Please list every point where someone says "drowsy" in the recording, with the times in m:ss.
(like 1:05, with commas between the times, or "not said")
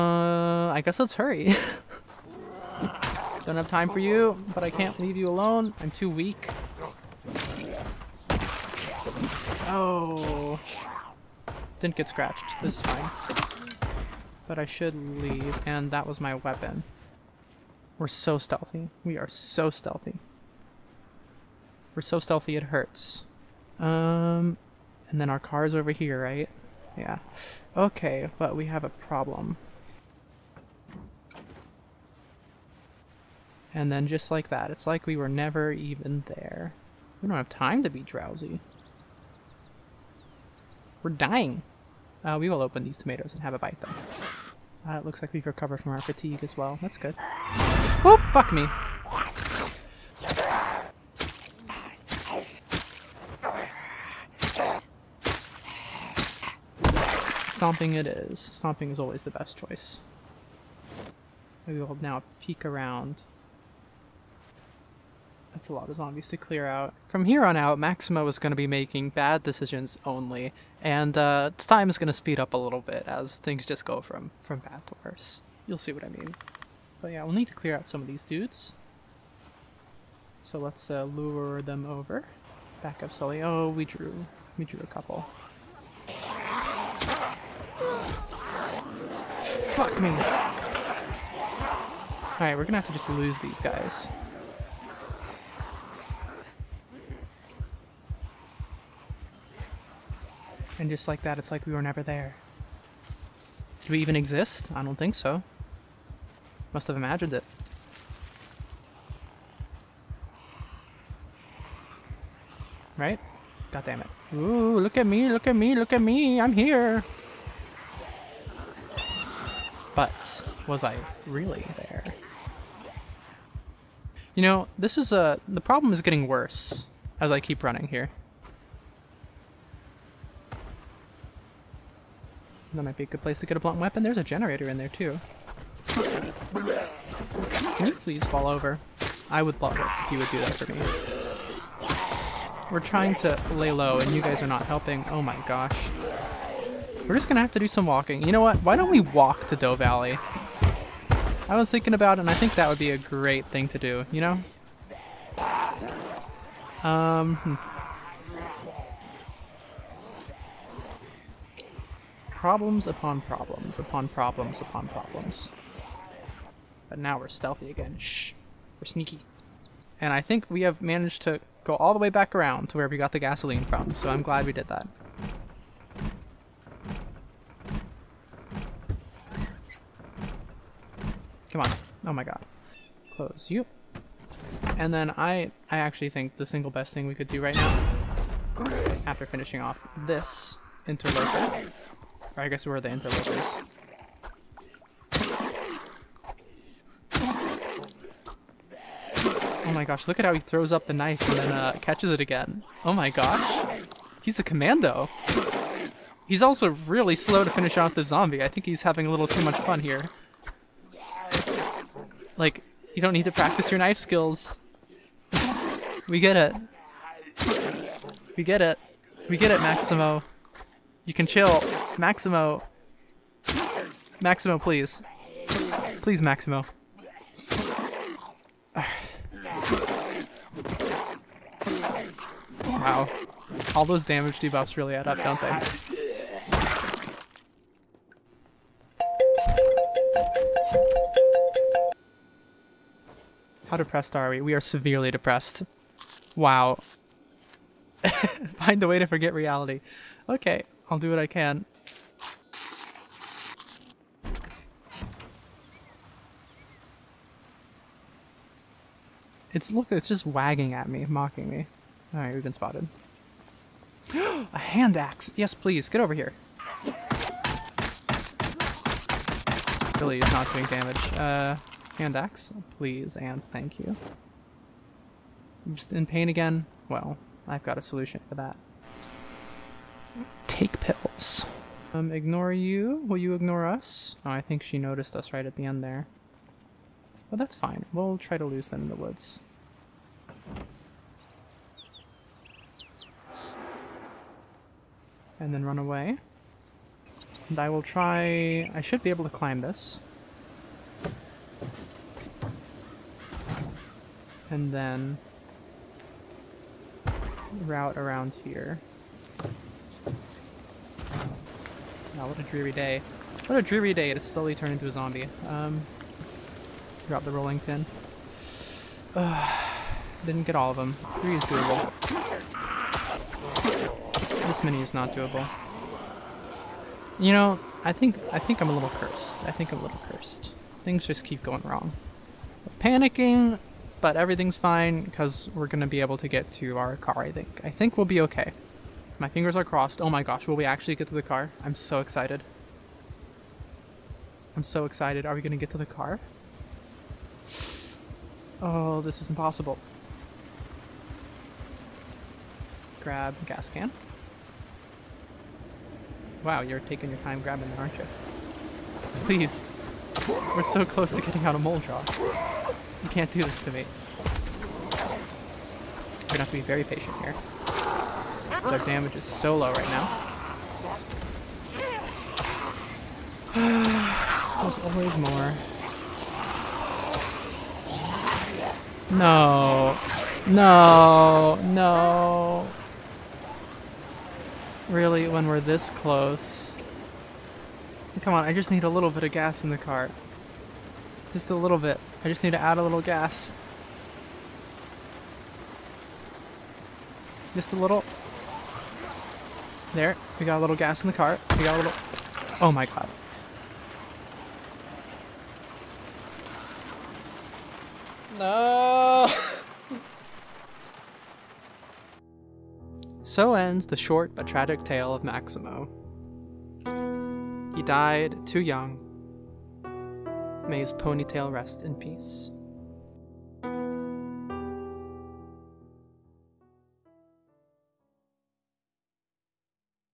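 0:38.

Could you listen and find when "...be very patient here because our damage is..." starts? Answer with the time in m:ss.
6:06.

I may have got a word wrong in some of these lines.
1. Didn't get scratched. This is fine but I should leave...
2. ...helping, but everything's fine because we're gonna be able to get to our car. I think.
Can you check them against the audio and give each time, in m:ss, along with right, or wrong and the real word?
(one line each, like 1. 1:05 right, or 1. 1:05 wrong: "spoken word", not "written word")
1. 0:11 right
2. 5:32 wrong: "panicking", not "helping".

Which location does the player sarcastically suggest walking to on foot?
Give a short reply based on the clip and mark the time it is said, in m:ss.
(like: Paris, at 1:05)
Doe Valley, at 2:29.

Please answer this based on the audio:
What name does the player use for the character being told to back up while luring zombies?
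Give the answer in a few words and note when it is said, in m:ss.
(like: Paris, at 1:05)
Sully, at 1:23.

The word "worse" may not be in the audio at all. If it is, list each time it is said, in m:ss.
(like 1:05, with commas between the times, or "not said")
1:15, 2:06.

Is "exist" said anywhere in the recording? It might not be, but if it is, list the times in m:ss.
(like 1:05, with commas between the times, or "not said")
1:44.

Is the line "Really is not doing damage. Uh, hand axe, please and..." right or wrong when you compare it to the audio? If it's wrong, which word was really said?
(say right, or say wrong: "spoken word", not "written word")
right.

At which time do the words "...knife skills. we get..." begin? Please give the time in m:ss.
3:33.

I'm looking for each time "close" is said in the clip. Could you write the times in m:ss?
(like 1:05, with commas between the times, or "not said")
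3:03, 6:00, 6:25.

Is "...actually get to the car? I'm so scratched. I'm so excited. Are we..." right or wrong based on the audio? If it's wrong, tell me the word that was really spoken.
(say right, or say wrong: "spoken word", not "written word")
wrong: "excited", not "scratched".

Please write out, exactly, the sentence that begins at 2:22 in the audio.
We're trying to lay low and you guys are not helping.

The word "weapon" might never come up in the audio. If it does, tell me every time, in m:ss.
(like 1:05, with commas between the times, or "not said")
0:16, 2:13.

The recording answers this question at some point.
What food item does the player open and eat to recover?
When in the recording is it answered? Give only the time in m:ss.
0:42.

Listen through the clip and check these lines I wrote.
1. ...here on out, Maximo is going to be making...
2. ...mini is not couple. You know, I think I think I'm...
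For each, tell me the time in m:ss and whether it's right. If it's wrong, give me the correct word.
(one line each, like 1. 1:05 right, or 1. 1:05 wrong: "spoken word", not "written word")
1. 1:07 right
2. 5:24 wrong: "doable", not "couple".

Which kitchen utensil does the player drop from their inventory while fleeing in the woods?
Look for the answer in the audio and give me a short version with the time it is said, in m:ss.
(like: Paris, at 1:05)
rolling pin, at 5:17.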